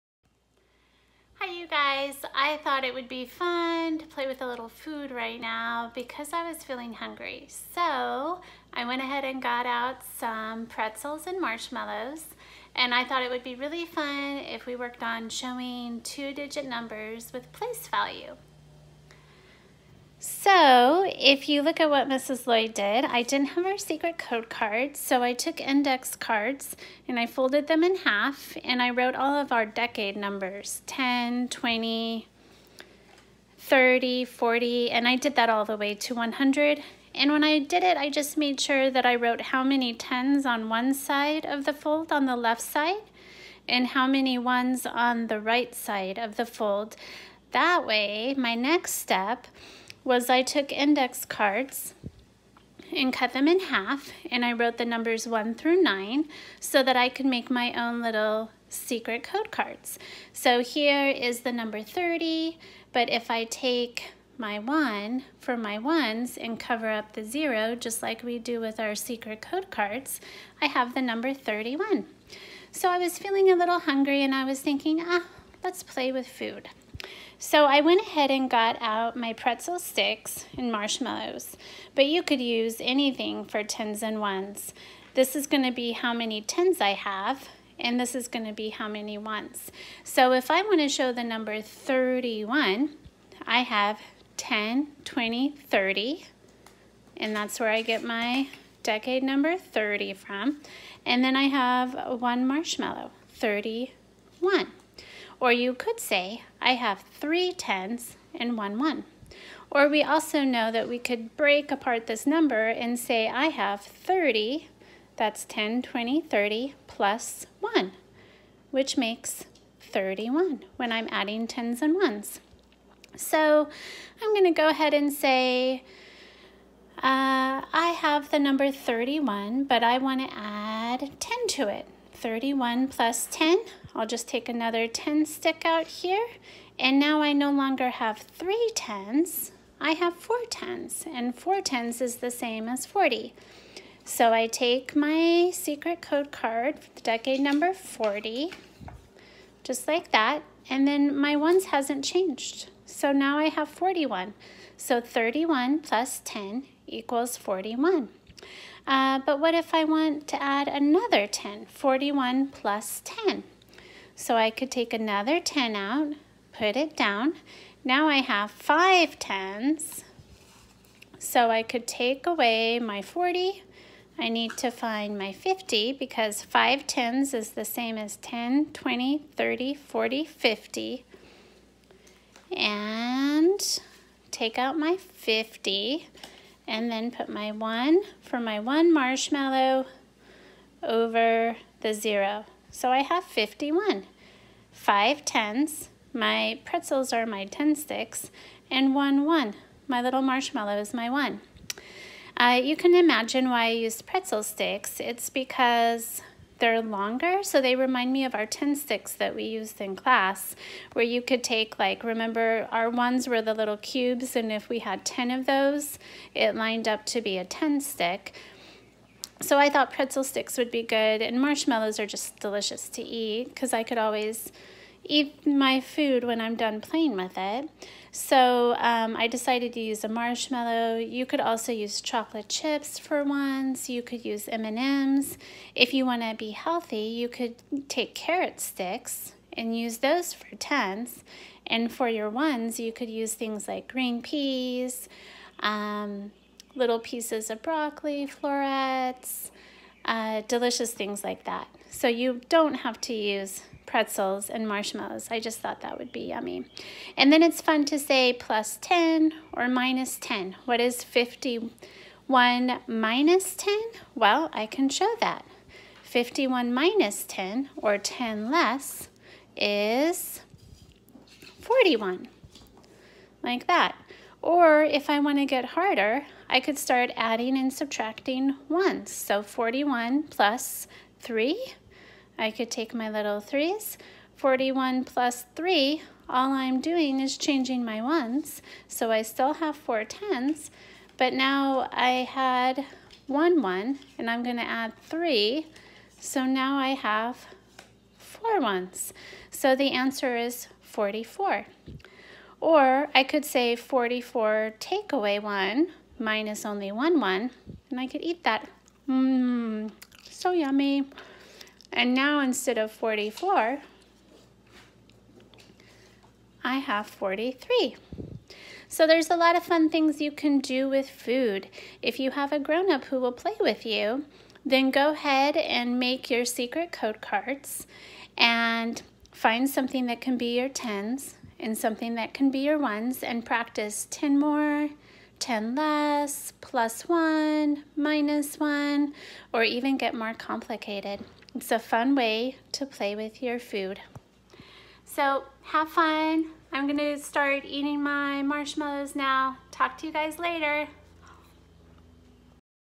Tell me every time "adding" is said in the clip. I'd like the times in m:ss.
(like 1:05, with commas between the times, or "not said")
2:01, 4:37.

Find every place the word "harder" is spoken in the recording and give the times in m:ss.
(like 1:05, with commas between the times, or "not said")
4:35.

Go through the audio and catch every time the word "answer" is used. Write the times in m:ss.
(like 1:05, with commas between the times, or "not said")
4:59.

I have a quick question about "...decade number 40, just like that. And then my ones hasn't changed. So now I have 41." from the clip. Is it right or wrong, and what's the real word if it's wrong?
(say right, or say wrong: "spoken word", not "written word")
right.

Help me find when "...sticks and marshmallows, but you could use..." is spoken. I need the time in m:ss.
1:19.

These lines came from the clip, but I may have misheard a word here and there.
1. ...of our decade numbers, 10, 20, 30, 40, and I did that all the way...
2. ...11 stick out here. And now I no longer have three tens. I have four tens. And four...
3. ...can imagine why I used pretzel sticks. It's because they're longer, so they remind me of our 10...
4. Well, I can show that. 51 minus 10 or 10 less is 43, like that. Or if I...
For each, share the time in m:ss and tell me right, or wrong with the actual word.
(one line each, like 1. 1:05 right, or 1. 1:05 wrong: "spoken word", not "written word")
1. 0:29 right
2. 2:14 wrong: "10", not "11"
3. 3:22 right
4. 4:24 wrong: "41", not "43".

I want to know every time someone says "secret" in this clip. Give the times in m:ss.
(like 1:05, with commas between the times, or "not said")
0:23, 0:58, 1:08, 2:25, 5:26.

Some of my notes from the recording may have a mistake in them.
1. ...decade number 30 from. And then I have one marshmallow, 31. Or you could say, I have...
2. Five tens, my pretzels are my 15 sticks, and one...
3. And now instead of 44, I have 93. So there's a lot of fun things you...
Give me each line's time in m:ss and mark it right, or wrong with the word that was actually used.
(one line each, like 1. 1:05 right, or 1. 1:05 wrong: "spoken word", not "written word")
1. 1:38 right
2. 3:14 wrong: "10", not "15"
3. 5:11 wrong: "43", not "93".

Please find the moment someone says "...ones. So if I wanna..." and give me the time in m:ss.
1:29.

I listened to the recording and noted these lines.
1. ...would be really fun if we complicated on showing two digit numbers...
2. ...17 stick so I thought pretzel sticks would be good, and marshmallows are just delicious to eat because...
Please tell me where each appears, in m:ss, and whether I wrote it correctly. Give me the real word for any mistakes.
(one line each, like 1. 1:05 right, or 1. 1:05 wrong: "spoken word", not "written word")
1. 0:13 wrong: "worked", not "complicated"
2. 3:37 wrong: "10", not "17".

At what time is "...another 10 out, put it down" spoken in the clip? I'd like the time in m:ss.
2:44.